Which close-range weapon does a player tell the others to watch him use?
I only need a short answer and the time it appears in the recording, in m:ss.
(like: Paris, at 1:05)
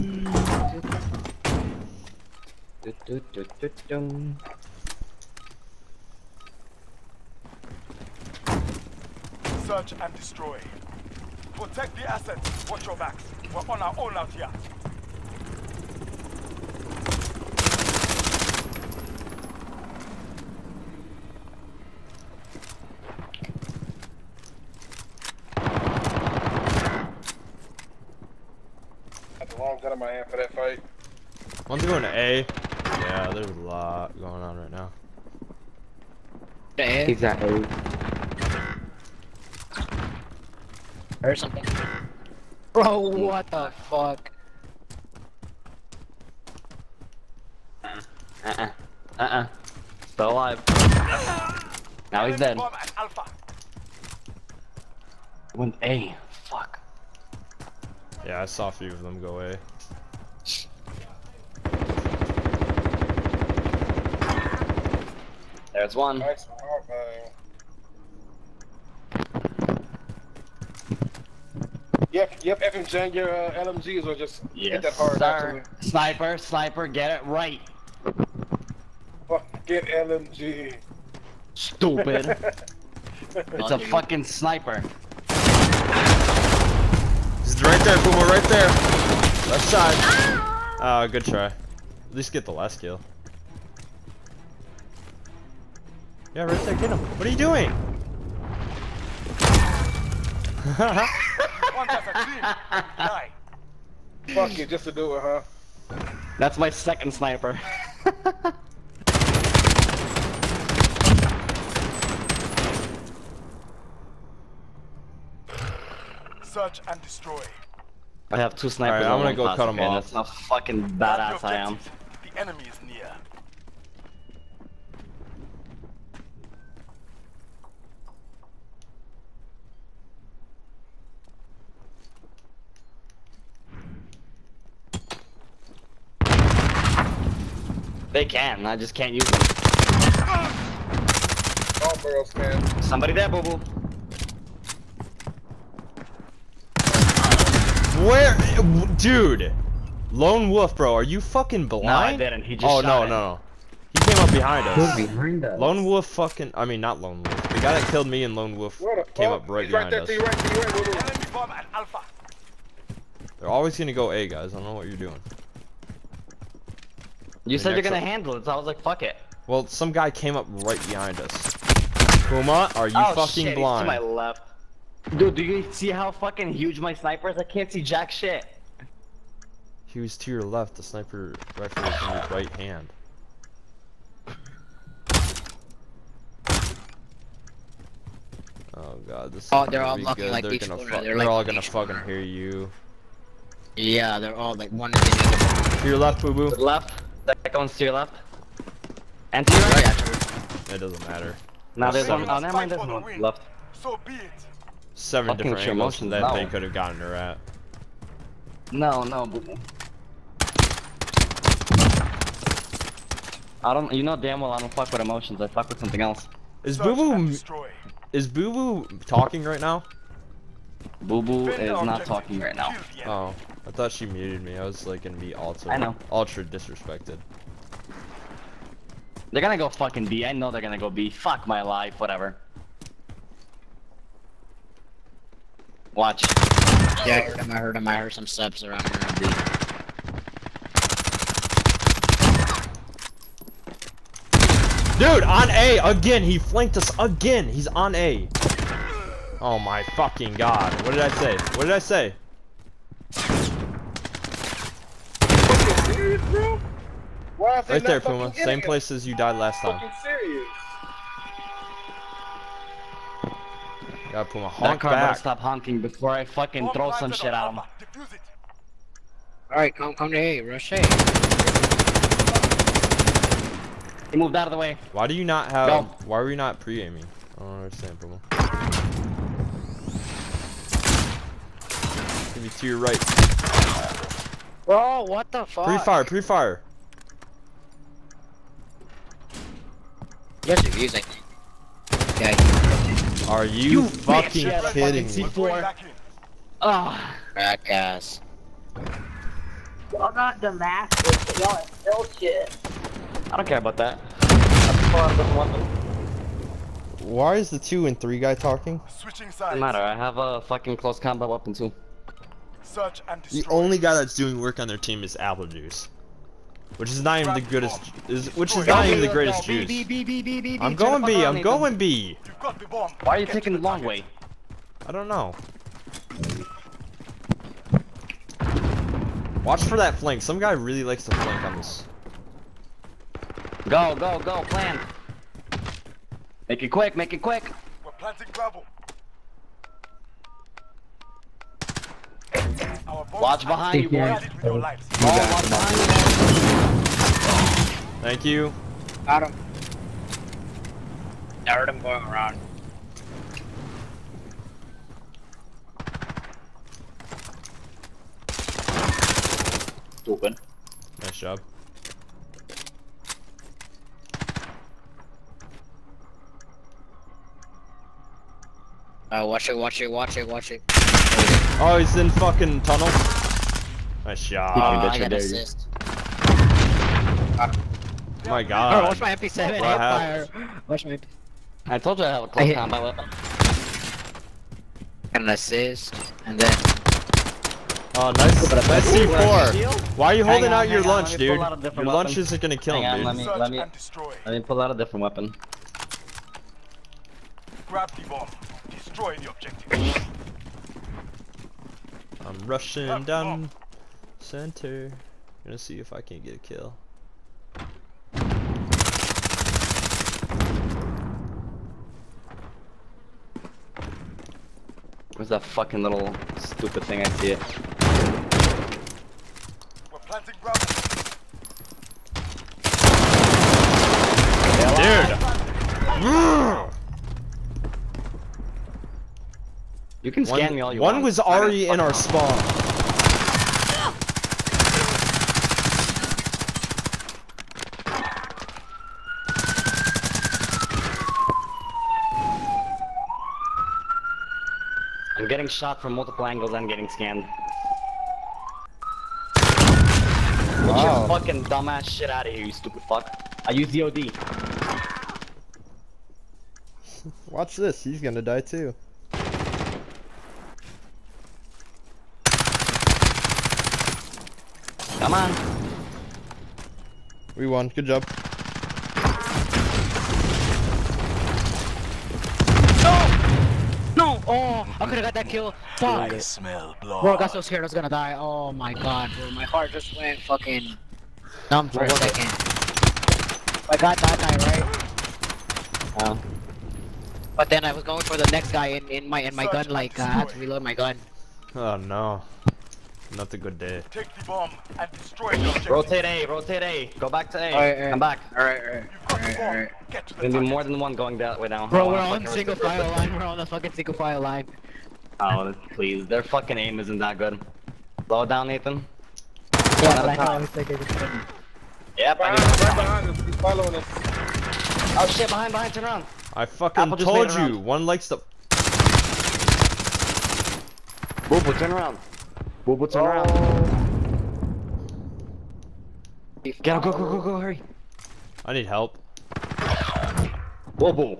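MP7, at 6:19.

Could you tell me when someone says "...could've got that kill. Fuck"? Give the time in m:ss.
7:54.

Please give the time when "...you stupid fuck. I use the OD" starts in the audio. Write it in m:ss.
7:32.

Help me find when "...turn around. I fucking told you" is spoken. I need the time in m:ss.
8:35.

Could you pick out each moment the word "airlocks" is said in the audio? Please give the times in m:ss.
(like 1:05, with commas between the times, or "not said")
not said.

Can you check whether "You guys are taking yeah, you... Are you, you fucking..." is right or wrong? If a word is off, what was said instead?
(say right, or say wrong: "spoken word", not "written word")
wrong: "using", not "taking".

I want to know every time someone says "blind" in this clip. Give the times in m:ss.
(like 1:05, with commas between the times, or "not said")
2:31, 2:53.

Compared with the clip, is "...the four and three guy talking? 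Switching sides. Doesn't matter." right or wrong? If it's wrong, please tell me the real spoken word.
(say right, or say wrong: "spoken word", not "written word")
wrong: "two", not "four".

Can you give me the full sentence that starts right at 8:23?
We're on the fucking single file line.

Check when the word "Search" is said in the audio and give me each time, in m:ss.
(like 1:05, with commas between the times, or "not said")
0:09, 1:56, 5:12.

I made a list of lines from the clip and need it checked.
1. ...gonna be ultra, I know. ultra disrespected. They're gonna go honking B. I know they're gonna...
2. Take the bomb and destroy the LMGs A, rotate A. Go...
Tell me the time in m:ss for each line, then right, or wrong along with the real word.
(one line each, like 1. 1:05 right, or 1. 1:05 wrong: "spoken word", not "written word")
1. 3:45 wrong: "fucking", not "honking"
2. 8:13 wrong: "Rotate", not "LMGs".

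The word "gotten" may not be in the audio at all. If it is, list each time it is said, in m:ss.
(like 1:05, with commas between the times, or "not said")
3:26.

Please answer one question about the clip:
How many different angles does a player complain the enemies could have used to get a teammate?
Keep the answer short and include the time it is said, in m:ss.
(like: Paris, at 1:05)
7, at 3:24.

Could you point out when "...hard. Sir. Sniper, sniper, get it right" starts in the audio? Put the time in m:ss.
1:14.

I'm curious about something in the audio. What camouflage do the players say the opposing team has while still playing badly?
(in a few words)
Damascus.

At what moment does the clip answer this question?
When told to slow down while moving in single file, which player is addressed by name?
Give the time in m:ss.
8:28.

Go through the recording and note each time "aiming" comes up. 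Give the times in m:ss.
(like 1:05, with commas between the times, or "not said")
4:36.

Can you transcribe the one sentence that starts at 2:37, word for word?
The guy that killed me and Lone Wolf came up right He's behind right there, us.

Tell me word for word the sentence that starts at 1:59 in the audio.
Right, I'm gonna go cut them off.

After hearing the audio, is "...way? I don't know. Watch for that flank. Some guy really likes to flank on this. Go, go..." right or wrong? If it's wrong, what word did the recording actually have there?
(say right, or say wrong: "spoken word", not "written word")
right.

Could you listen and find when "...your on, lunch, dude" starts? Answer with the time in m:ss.
6:30.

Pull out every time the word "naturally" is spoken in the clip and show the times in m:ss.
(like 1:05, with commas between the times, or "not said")
not said.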